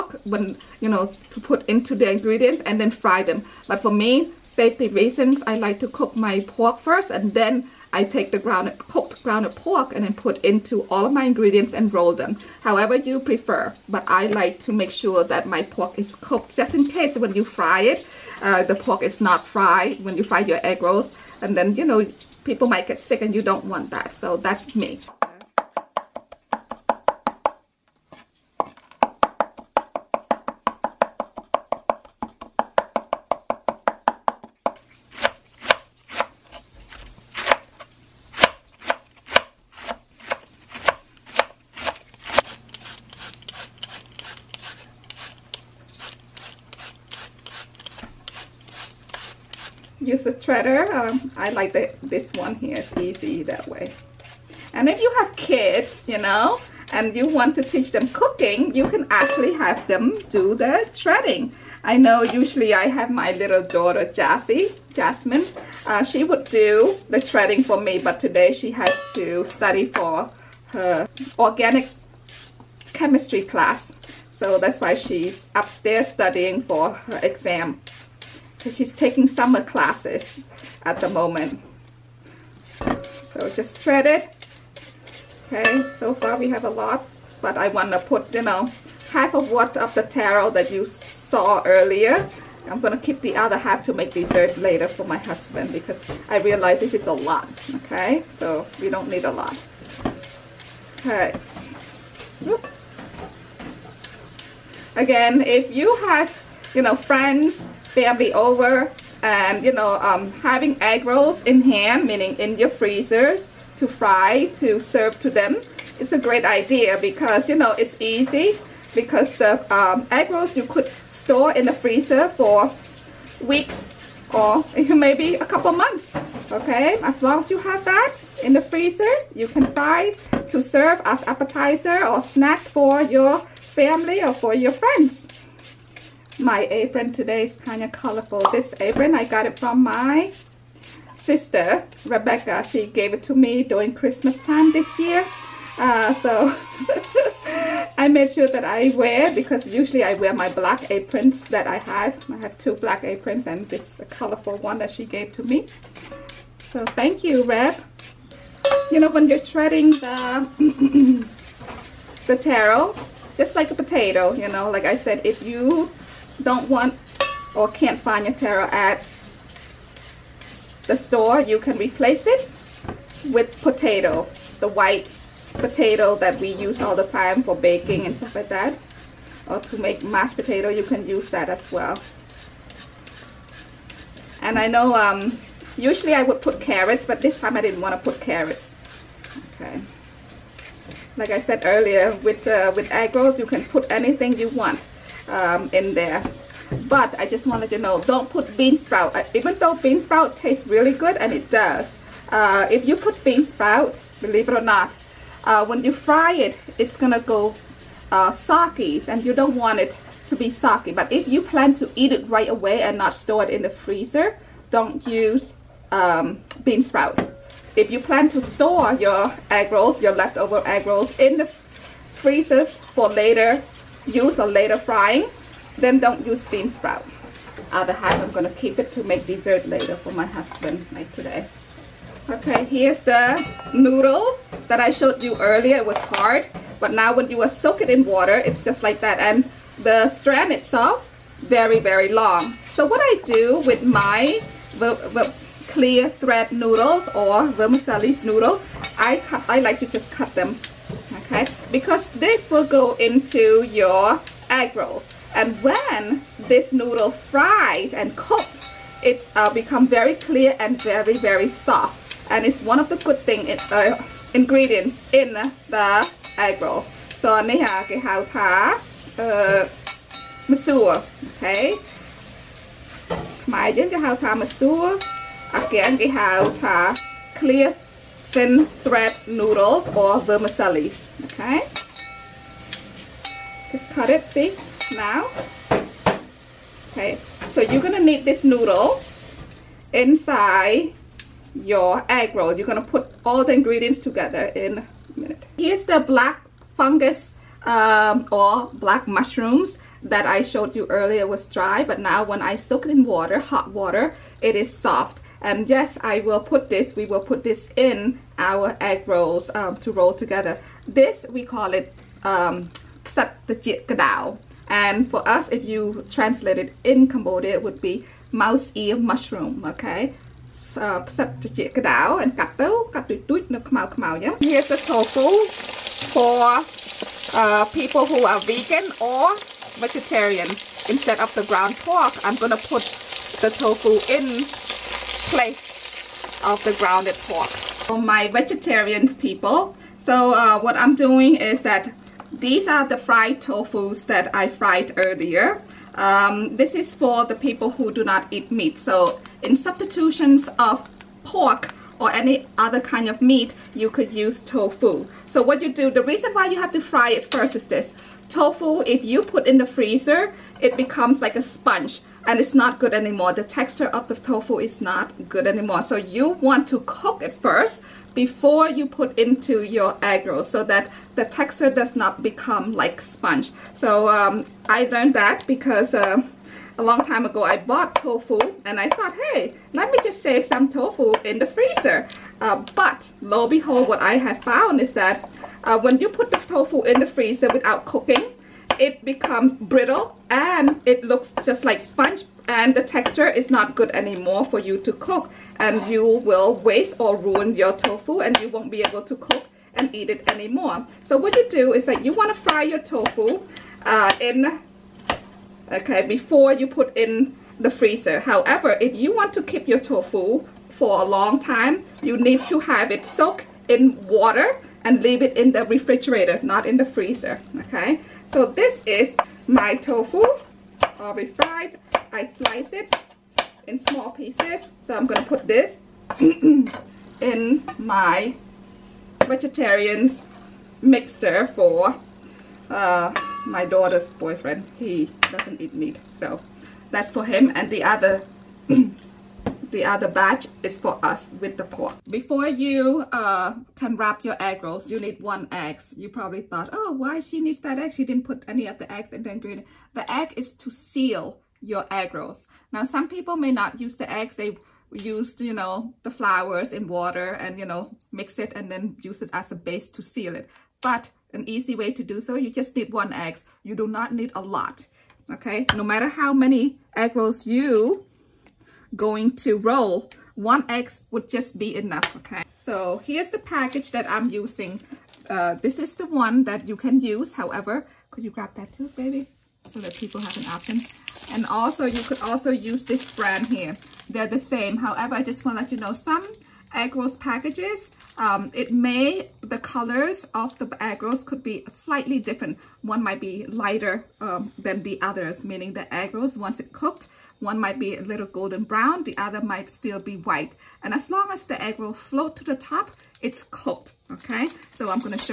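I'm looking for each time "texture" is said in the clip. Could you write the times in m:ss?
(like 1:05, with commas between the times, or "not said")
6:03, 6:11, 6:32.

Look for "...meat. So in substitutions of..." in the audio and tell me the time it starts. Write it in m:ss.
5:48.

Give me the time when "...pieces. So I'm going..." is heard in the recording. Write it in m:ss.
7:04.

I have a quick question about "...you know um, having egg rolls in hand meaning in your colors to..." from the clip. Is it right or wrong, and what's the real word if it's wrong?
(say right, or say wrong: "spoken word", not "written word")
wrong: "freezers", not "colors".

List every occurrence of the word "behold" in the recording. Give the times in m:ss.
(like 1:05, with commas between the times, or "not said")
6:23.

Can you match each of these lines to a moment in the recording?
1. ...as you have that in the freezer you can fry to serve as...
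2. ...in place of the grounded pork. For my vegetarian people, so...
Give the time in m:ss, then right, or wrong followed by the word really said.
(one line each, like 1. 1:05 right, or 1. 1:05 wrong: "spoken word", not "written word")
1. 2:07 right
2. 5:34 right.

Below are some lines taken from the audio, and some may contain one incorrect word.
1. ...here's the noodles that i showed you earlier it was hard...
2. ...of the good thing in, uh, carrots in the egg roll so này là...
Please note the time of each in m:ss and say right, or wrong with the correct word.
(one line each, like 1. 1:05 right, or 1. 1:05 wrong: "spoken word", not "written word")
1. 3:52 right
2. 4:22 wrong: "ingredients", not "carrots".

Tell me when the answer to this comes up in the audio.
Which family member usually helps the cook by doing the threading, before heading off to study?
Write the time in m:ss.
1:04.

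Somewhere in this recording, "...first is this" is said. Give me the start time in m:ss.
5:57.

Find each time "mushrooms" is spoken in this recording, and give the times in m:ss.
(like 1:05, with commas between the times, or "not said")
4:59, 5:18.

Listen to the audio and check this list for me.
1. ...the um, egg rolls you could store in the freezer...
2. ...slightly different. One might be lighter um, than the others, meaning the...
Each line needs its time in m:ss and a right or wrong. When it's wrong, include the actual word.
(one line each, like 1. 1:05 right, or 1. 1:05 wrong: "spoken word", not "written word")
1. 1:59 right
2. 8:11 right.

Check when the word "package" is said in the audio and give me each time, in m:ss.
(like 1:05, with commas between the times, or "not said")
7:53, 8:07.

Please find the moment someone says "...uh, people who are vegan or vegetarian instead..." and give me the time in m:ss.
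5:27.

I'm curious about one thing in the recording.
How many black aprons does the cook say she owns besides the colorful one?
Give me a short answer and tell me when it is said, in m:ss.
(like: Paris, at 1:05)
2, at 2:32.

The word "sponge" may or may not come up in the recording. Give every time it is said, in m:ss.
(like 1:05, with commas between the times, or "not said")
6:01, 6:12, 6:31.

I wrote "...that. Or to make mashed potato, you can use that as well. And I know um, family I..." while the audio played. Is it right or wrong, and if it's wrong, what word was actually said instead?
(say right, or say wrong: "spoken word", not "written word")
wrong: "usually", not "family".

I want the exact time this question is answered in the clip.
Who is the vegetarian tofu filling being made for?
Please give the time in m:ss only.
7:13.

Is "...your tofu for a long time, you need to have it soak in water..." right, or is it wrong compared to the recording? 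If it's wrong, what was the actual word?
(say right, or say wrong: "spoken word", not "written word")
right.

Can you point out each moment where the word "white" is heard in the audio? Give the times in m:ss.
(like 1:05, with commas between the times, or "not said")
2:54, 8:20.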